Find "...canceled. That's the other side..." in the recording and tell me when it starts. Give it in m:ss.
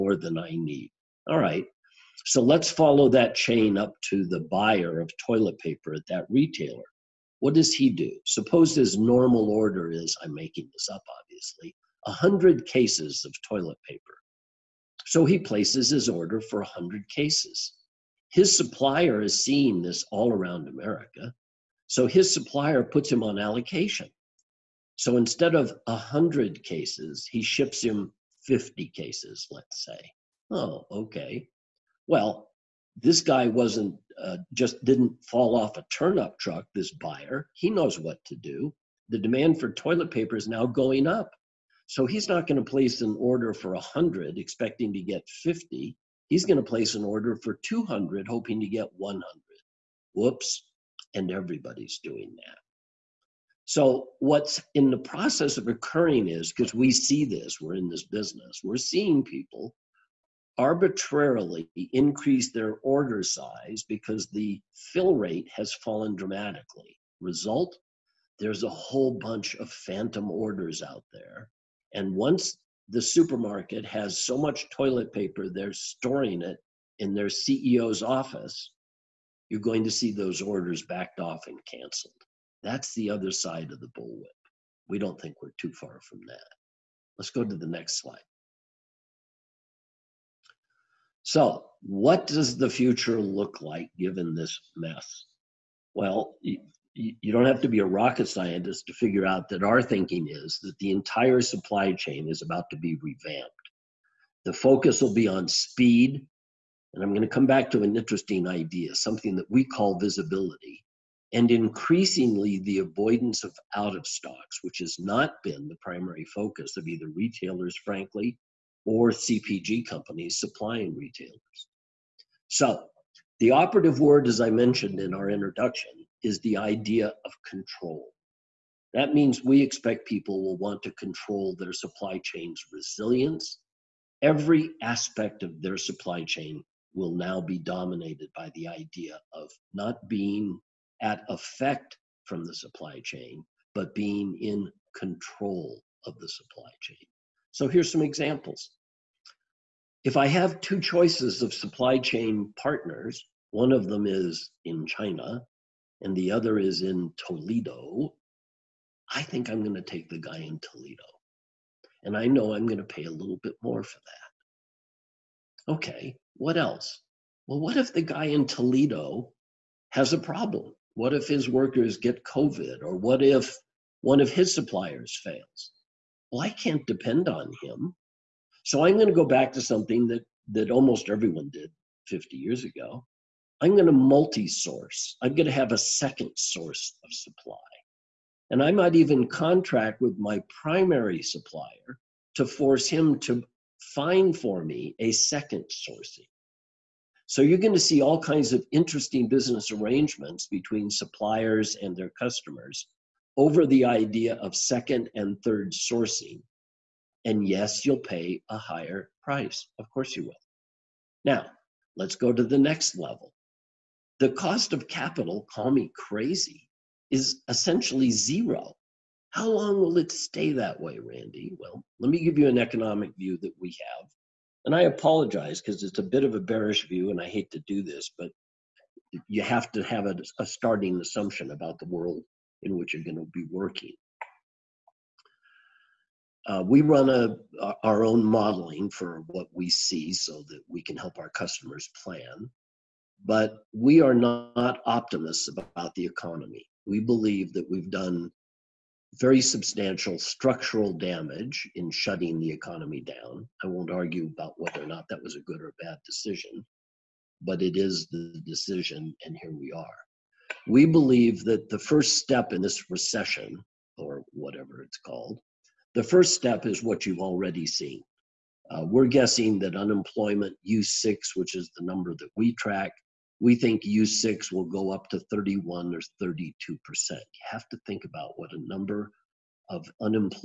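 1:21.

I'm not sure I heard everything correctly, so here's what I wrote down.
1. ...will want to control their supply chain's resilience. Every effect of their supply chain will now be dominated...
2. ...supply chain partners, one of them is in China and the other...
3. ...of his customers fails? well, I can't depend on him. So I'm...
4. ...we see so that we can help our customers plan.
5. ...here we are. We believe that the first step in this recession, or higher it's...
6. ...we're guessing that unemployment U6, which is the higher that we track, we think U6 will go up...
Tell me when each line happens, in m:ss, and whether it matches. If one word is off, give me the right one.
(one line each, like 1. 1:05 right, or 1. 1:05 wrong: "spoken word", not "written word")
1. 2:10 wrong: "aspect", not "effect"
2. 2:31 right
3. 2:54 wrong: "suppliers", not "customers"
4. 3:59 right
5. 4:19 wrong: "whatever", not "higher"
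6. 4:28 wrong: "number", not "higher".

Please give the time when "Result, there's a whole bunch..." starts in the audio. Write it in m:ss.
1:07.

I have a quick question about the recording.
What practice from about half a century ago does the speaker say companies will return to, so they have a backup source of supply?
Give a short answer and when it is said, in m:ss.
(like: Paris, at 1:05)
multi source, at 3:03.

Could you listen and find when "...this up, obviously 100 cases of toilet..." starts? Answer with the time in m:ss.
0:10.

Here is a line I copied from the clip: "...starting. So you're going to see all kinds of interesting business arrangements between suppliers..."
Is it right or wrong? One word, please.
wrong.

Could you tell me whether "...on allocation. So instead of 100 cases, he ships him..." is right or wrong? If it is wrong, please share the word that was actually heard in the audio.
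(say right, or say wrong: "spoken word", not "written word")
right.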